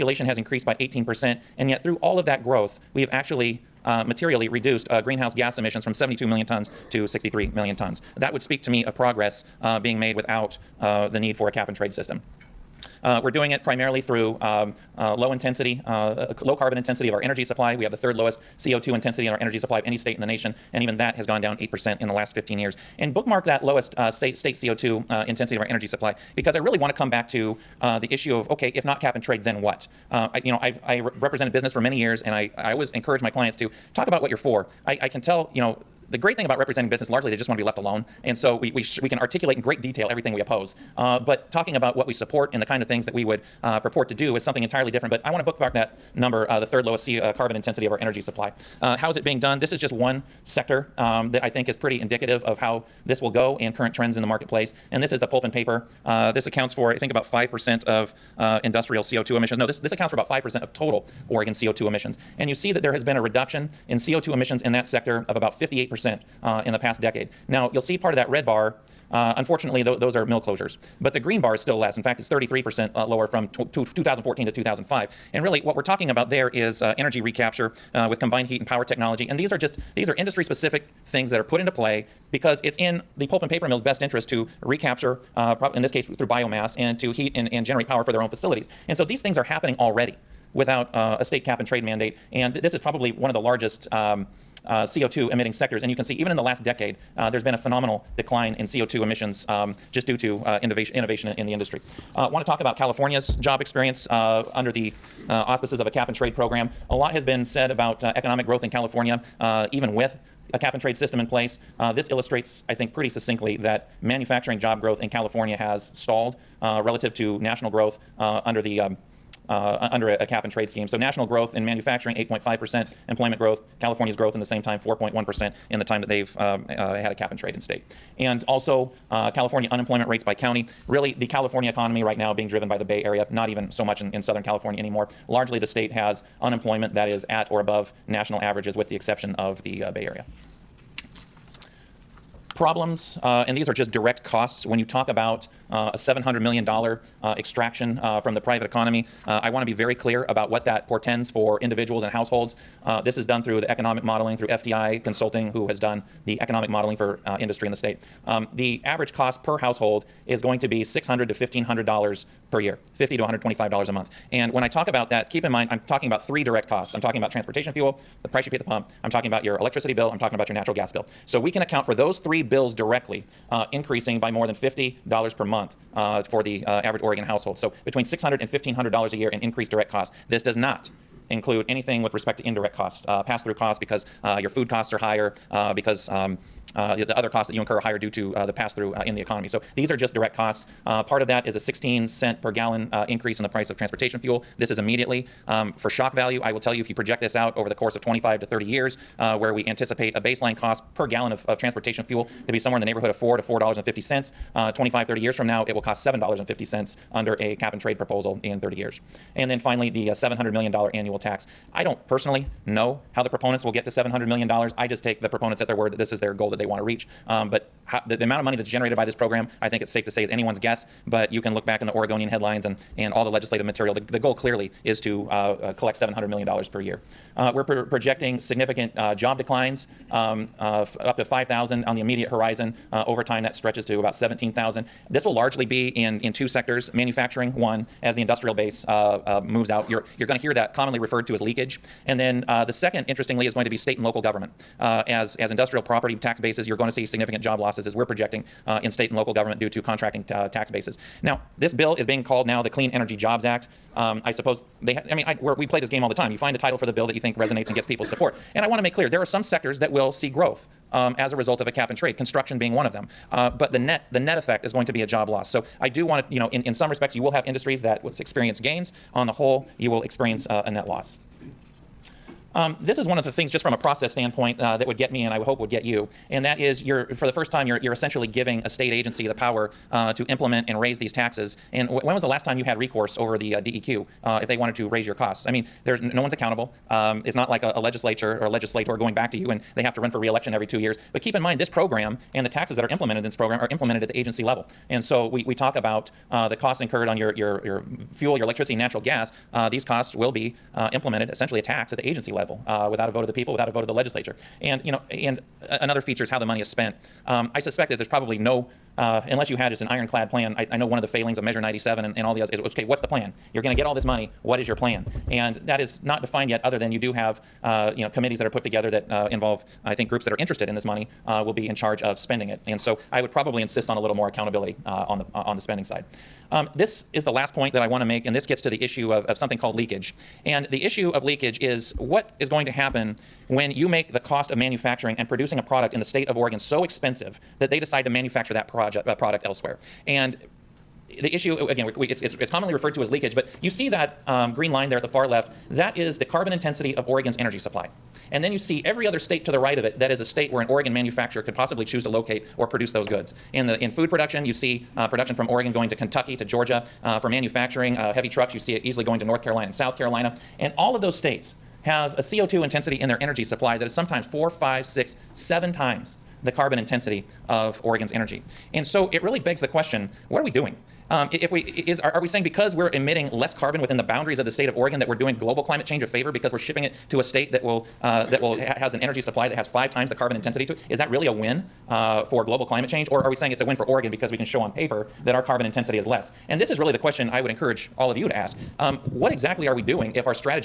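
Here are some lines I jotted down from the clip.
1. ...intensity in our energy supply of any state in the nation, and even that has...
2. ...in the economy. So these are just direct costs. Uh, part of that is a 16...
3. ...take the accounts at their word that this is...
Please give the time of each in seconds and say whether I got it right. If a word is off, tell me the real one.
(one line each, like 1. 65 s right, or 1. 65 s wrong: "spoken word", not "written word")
1. 18 s right
2. 189 s right
3. 215 s wrong: "proponents", not "accounts".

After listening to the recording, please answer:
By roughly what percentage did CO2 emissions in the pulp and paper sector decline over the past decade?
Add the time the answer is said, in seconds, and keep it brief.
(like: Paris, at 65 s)
58%, at 65 s.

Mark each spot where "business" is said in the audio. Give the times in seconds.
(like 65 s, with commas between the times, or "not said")
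31 s, 36 s.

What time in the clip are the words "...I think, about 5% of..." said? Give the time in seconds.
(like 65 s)
56 s.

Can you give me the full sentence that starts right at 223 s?
The, the goal clearly is to uh, uh, collect $700 million per year.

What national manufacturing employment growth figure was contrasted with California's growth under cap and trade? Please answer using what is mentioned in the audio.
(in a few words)
8.5%.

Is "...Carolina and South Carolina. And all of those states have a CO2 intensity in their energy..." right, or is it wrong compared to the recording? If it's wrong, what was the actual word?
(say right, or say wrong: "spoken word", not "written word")
right.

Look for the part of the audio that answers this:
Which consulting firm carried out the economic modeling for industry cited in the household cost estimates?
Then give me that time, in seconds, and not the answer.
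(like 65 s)
154 s.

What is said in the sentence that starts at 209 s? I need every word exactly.
And then finally, the uh, $700 million annual tax.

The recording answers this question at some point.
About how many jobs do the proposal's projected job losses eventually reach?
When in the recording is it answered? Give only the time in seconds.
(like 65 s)
234 s.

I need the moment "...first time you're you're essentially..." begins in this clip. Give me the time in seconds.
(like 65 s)
277 s.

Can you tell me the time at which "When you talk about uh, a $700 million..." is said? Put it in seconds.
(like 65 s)
144 s.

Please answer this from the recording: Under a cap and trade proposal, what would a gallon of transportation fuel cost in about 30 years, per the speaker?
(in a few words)
$7.50.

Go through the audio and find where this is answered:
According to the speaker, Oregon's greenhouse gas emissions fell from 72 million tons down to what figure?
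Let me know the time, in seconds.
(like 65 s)
7 s.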